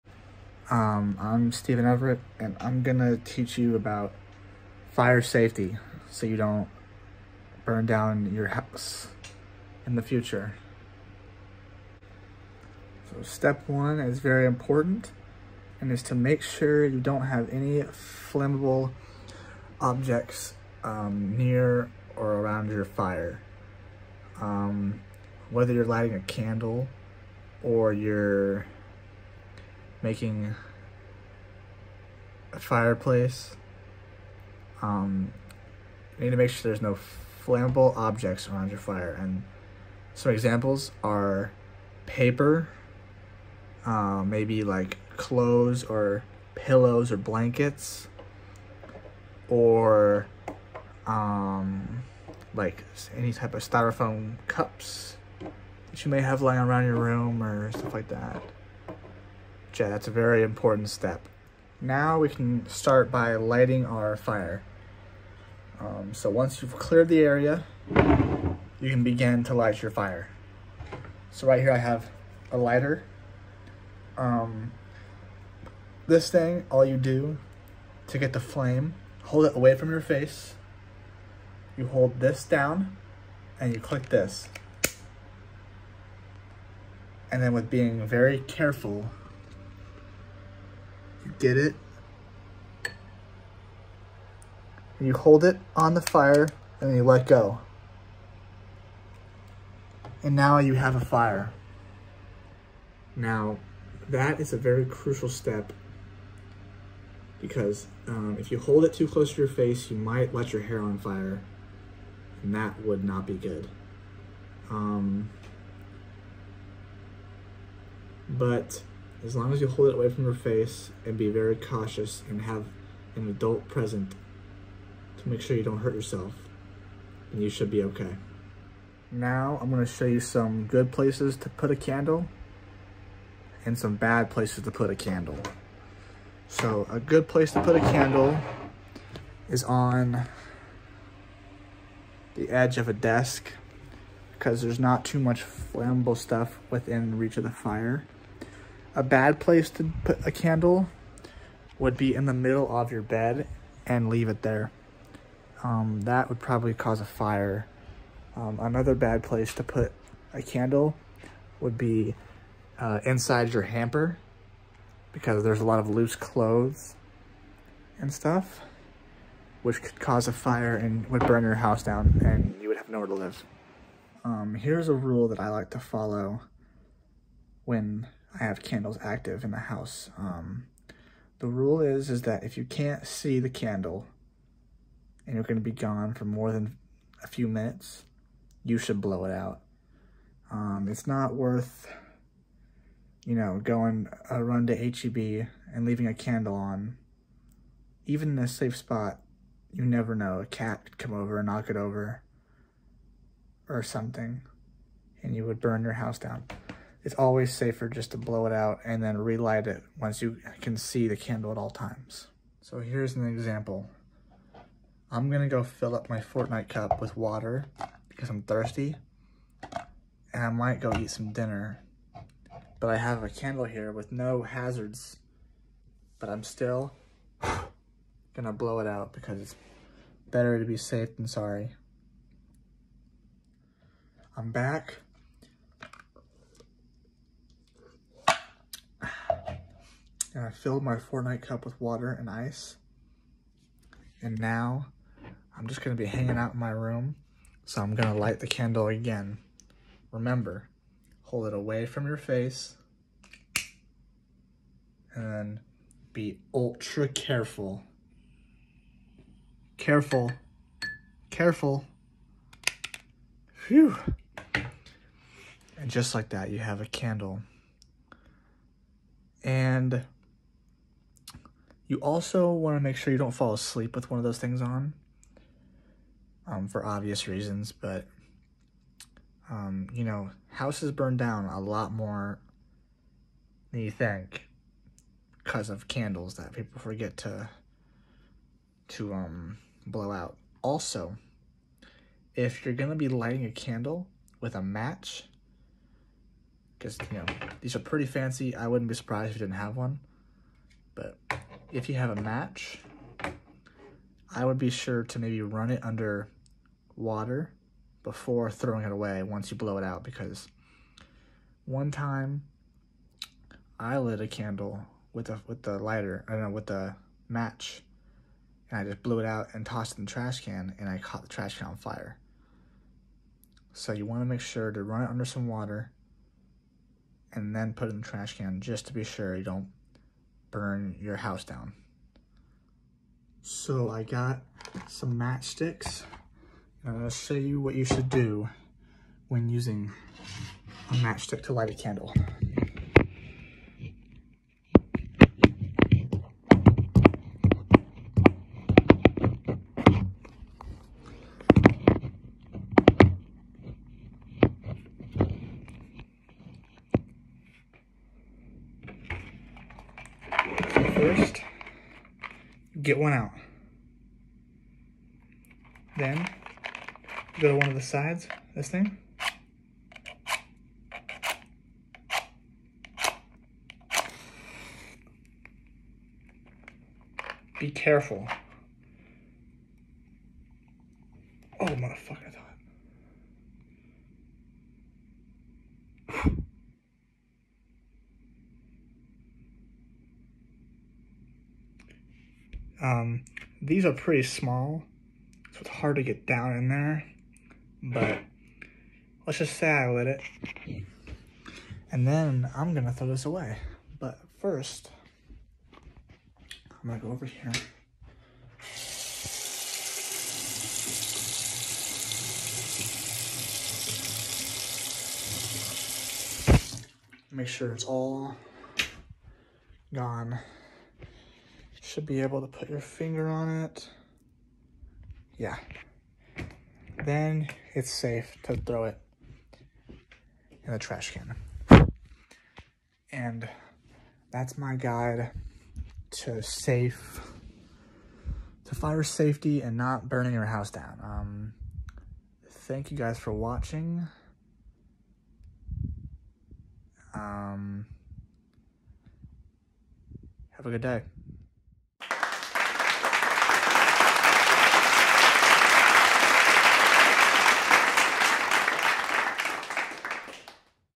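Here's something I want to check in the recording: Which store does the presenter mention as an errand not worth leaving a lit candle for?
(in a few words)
HEB.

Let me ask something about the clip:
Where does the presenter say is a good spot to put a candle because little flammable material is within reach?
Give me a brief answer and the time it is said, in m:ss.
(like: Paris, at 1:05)
edge of a desk, at 2:22.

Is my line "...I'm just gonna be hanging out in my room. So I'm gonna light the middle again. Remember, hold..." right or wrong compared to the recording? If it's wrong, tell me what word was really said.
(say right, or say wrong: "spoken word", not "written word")
wrong: "candle", not "middle".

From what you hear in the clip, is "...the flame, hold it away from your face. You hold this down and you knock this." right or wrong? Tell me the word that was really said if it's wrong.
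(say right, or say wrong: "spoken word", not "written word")
wrong: "click", not "knock".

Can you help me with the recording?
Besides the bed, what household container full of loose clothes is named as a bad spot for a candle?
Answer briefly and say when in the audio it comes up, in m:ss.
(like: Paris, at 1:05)
hamper, at 2:43.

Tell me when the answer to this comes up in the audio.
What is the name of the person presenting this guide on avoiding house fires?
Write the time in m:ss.
0:01.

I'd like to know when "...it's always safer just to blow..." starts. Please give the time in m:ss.
3:27.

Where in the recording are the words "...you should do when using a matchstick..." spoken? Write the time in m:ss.
5:37.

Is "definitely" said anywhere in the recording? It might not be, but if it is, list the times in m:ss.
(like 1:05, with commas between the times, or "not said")
not said.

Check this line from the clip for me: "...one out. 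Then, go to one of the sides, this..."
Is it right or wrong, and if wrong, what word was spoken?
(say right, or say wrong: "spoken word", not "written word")
right.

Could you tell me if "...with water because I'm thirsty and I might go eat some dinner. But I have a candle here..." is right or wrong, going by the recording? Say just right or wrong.
right.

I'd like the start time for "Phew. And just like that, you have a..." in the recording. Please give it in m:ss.
4:23.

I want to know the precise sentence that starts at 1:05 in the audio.
Um, so once you've cleared the area, you can begin to light your fire.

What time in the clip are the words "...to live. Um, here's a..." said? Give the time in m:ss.
2:53.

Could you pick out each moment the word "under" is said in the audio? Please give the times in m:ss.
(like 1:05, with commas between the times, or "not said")
5:05, 5:25.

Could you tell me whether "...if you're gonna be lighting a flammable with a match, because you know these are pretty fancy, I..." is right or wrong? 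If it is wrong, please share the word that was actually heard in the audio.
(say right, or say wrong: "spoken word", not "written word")
wrong: "candle", not "flammable".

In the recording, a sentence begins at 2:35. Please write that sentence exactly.
Um, that would probably cause a fire.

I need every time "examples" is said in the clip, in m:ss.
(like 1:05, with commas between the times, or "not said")
0:40, 3:33.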